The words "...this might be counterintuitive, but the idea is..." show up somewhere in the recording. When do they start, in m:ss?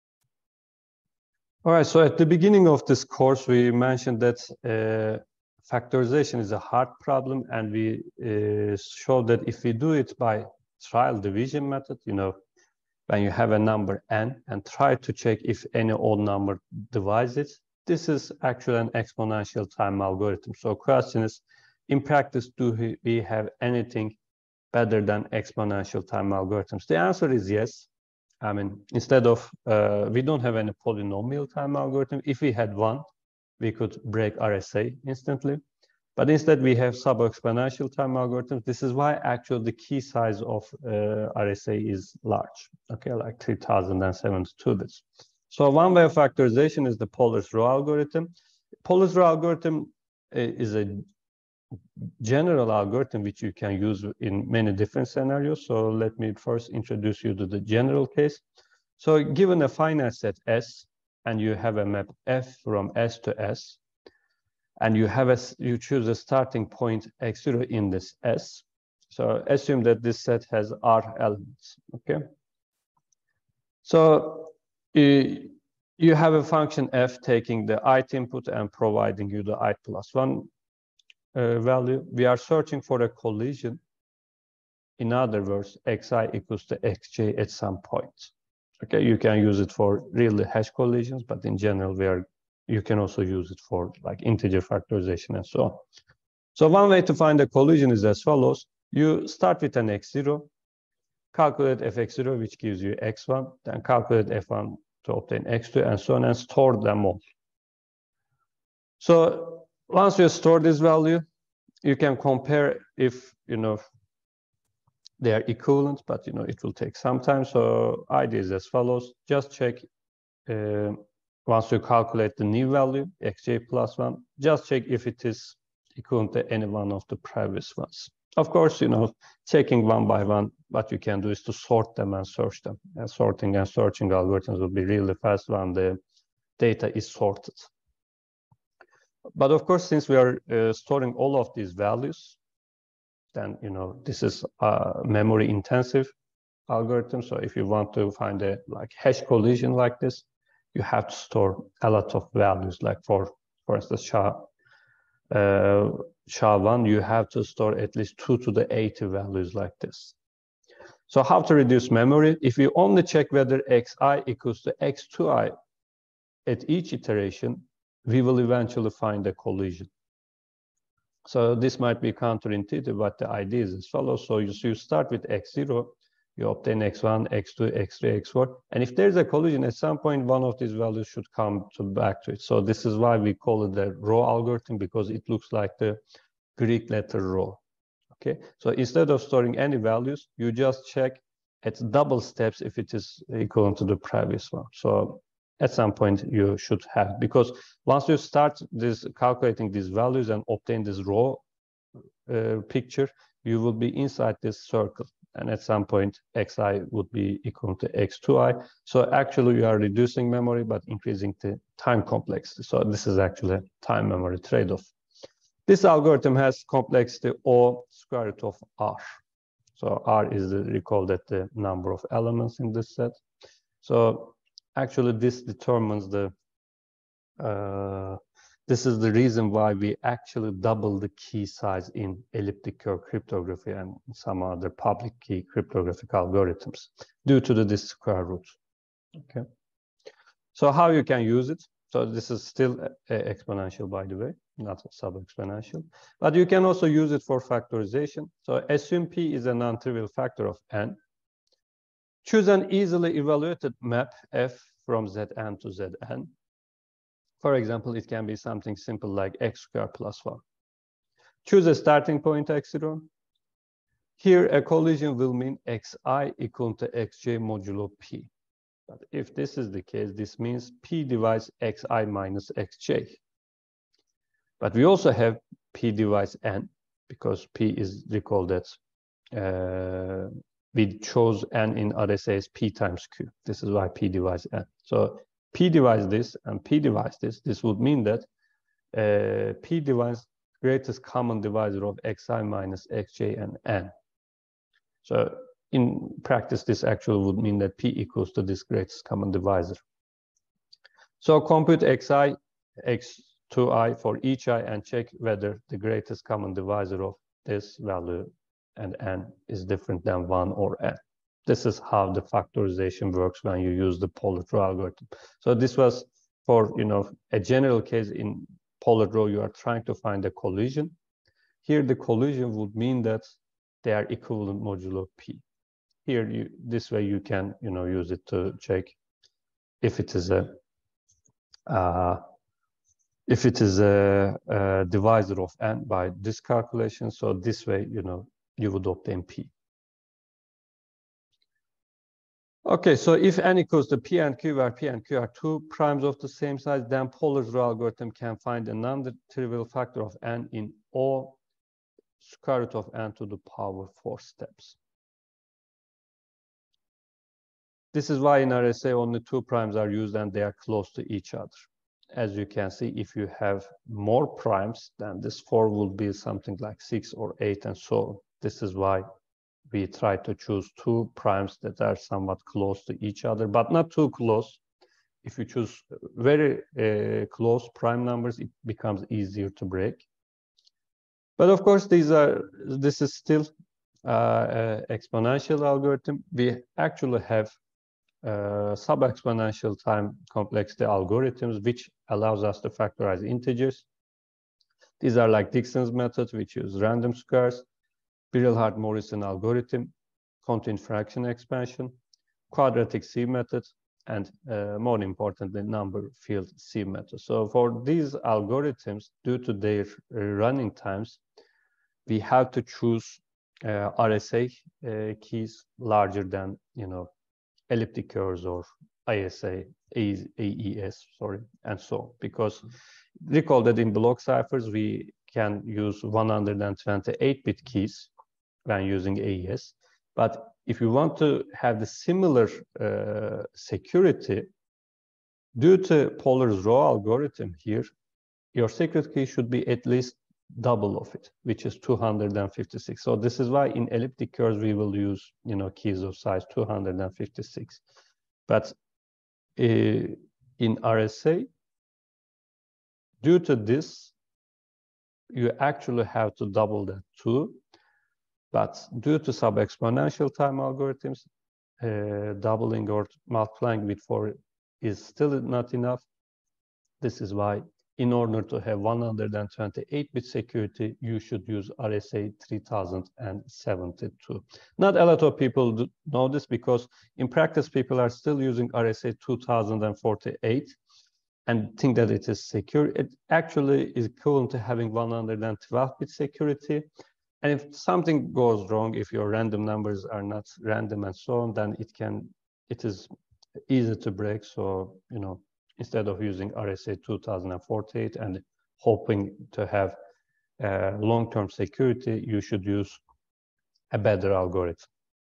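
2:51.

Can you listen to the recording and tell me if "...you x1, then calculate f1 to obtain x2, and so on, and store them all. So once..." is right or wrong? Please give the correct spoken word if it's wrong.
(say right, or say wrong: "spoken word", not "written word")
right.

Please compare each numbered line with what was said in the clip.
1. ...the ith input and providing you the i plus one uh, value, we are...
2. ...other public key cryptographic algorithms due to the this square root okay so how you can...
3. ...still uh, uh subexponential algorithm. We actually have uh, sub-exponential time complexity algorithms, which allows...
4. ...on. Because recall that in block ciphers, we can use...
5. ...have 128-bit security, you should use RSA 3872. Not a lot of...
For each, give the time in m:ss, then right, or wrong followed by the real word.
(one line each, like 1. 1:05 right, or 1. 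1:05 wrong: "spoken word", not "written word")
1. 1:17 right
2. 3:54 right
3. 6:23 wrong: "exponential", not "subexponential"
4. 7:01 right
5. 7:48 wrong: "3072", not "3872".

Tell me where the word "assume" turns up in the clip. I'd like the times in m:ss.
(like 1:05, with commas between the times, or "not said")
1:09, 4:08.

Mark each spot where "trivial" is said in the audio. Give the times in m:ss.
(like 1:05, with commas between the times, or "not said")
4:09, 5:48.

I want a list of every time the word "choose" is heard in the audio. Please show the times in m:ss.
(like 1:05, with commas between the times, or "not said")
1:05, 4:12, 4:21, 6:10, 6:15, 6:52.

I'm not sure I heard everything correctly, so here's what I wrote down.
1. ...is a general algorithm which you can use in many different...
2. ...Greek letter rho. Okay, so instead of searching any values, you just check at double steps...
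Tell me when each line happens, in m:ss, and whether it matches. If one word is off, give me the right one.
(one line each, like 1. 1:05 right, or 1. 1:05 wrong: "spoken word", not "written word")
1. 0:50 right
2. 3:06 wrong: "storing", not "searching".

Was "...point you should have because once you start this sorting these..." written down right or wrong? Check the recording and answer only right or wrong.
wrong.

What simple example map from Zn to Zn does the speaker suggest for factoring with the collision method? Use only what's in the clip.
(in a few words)
x squared plus 1.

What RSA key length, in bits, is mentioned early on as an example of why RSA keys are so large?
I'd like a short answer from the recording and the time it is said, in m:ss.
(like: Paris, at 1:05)
3072, at 0:43.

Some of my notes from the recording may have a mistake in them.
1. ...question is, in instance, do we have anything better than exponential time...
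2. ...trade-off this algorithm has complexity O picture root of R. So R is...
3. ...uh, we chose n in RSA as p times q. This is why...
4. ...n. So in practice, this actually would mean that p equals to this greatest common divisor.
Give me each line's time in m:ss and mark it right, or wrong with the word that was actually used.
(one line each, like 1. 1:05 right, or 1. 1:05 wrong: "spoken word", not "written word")
1. 0:20 wrong: "practice", not "instance"
2. 3:34 wrong: "square", not "picture"
3. 4:39 right
4. 4:53 right.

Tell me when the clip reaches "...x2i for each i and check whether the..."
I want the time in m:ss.
5:02.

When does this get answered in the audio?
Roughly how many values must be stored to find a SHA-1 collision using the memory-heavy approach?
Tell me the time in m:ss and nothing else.
2:38.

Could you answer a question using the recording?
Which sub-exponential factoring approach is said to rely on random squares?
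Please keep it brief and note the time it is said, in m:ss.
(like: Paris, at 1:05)
Dixon's method, at 6:35.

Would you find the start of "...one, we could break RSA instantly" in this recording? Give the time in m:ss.
0:32.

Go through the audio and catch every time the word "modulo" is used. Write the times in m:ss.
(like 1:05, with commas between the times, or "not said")
4:27, 5:24.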